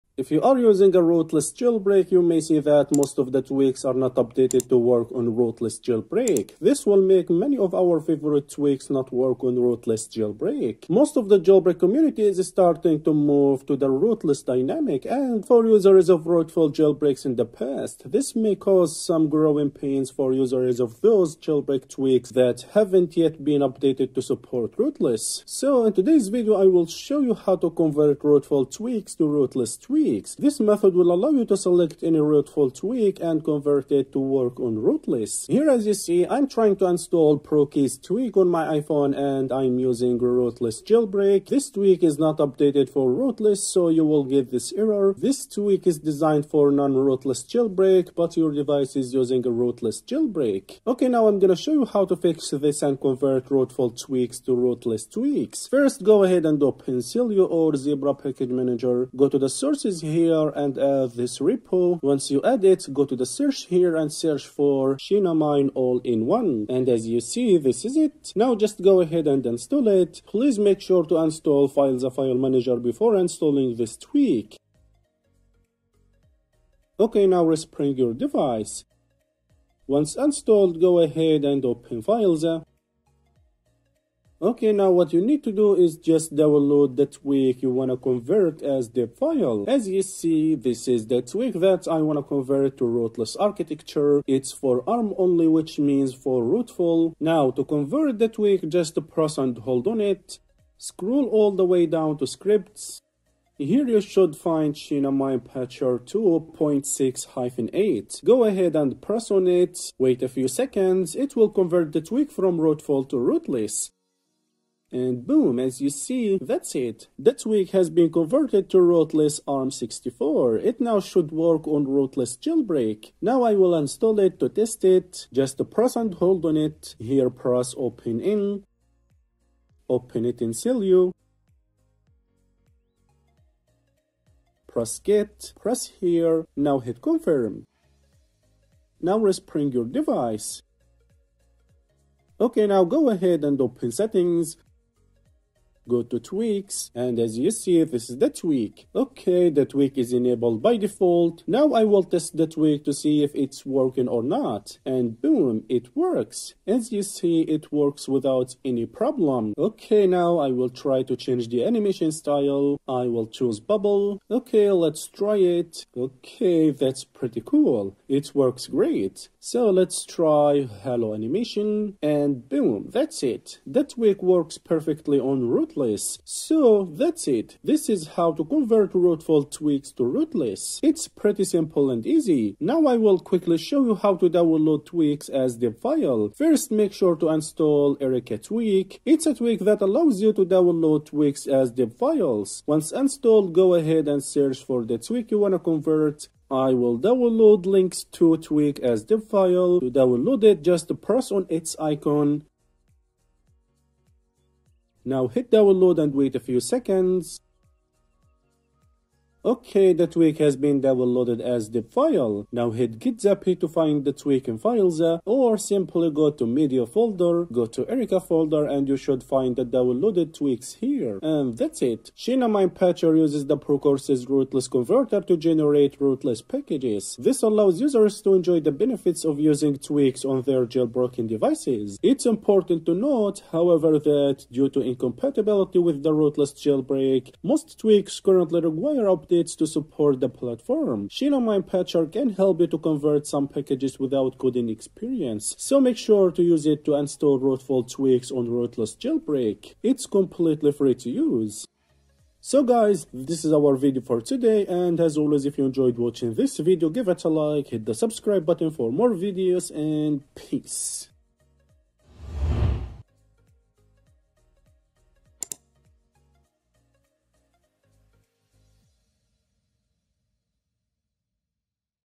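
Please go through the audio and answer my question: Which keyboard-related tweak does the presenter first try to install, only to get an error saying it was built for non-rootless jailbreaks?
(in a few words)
ProKeys.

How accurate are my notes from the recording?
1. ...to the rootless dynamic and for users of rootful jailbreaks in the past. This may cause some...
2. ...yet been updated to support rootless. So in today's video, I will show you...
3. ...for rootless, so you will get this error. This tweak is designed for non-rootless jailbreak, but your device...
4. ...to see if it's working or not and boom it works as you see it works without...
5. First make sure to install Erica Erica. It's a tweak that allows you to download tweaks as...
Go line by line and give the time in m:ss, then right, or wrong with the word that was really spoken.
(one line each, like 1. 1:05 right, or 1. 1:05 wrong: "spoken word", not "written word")
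1. 0:13 right
2. 0:23 right
3. 0:42 right
4. 2:32 right
5. 3:06 wrong: "Tweak", not "Erica".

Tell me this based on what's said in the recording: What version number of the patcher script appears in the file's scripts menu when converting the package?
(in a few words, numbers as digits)
2.6-8.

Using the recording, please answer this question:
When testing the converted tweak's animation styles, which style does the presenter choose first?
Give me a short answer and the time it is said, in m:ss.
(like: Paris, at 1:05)
bubble, at 2:43.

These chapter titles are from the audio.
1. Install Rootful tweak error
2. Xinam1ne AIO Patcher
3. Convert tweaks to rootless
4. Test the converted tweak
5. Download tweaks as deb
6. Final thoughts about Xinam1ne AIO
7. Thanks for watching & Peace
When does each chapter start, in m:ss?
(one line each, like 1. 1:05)
1. 0:36
2. 1:05
3. 1:37
4. 2:05
5. 3:02
6. 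3:42
7. 4:12.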